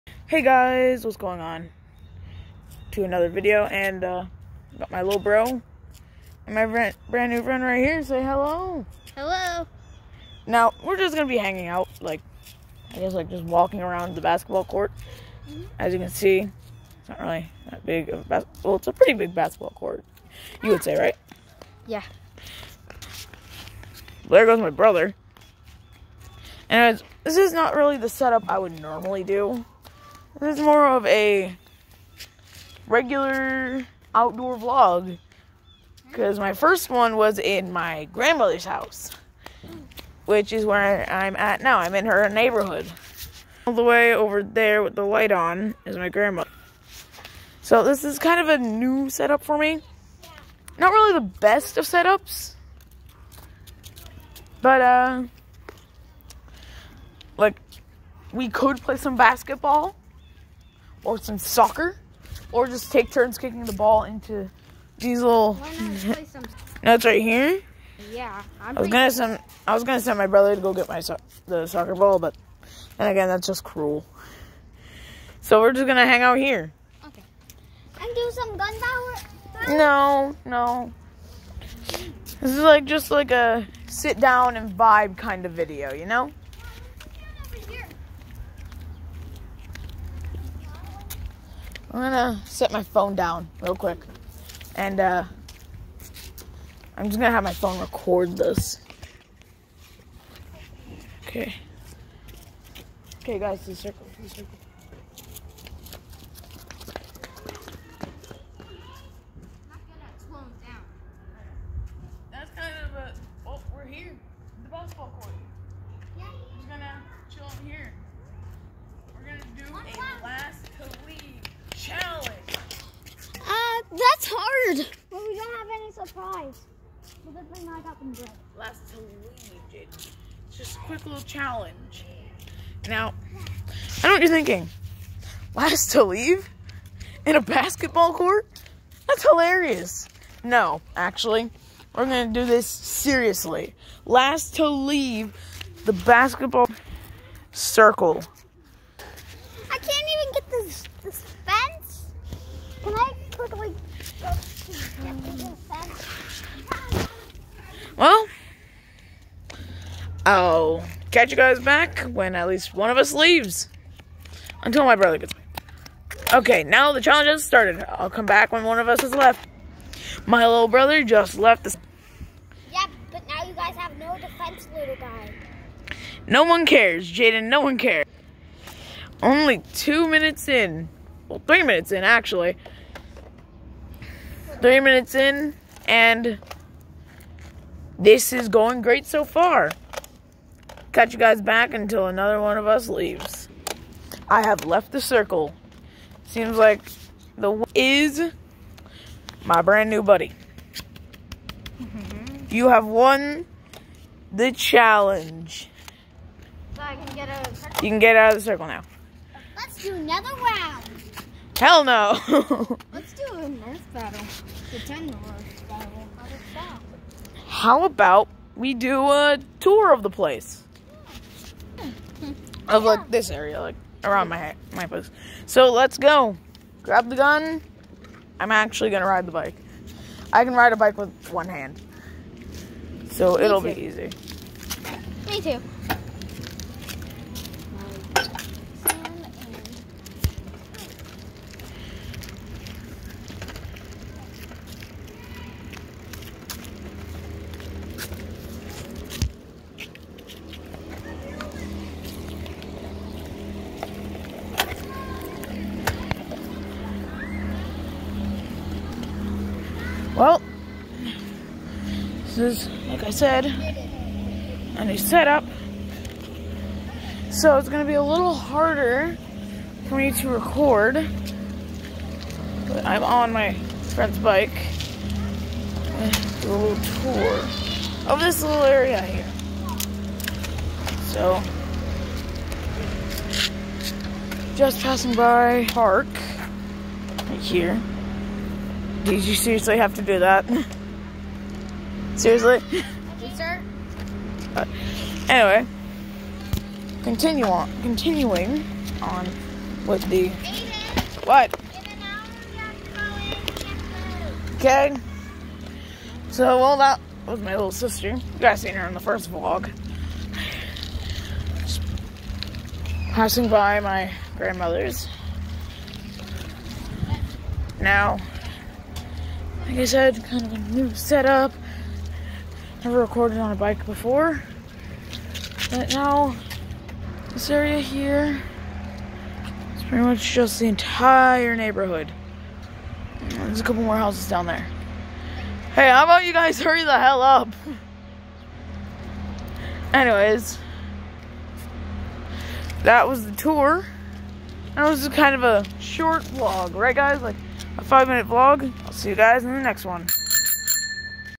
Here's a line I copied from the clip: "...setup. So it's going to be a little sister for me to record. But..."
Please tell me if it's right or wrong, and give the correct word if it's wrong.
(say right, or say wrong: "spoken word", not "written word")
wrong: "harder", not "sister".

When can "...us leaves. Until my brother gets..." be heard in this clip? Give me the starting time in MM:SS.
02:42.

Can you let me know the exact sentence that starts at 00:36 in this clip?
Because my first one was in my grandmother's house, which is where I'm at now.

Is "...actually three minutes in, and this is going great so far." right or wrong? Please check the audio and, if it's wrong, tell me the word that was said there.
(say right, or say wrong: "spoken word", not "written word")
right.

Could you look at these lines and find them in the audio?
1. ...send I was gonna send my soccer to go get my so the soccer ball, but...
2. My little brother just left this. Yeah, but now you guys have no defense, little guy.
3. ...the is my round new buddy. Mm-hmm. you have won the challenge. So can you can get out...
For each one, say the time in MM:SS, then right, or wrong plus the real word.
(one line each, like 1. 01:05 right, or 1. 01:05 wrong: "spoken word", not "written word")
1. 01:09 wrong: "brother", not "soccer"
2. 02:50 right
3. 03:17 wrong: "brand", not "round".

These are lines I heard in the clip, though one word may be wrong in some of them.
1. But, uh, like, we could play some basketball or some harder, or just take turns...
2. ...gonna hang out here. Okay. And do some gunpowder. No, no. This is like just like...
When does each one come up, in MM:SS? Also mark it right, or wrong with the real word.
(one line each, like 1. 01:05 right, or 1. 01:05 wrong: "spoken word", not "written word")
1. 00:54 wrong: "soccer", not "harder"
2. 01:15 right.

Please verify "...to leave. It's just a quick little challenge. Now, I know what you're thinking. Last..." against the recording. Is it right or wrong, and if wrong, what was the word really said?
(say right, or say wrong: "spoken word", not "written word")
right.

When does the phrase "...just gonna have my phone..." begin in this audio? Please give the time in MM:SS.
01:37.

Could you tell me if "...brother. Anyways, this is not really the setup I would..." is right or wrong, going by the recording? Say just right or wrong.
right.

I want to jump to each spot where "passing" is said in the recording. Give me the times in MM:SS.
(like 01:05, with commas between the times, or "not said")
04:44, 05:13.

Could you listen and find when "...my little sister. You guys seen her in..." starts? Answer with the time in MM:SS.
05:07.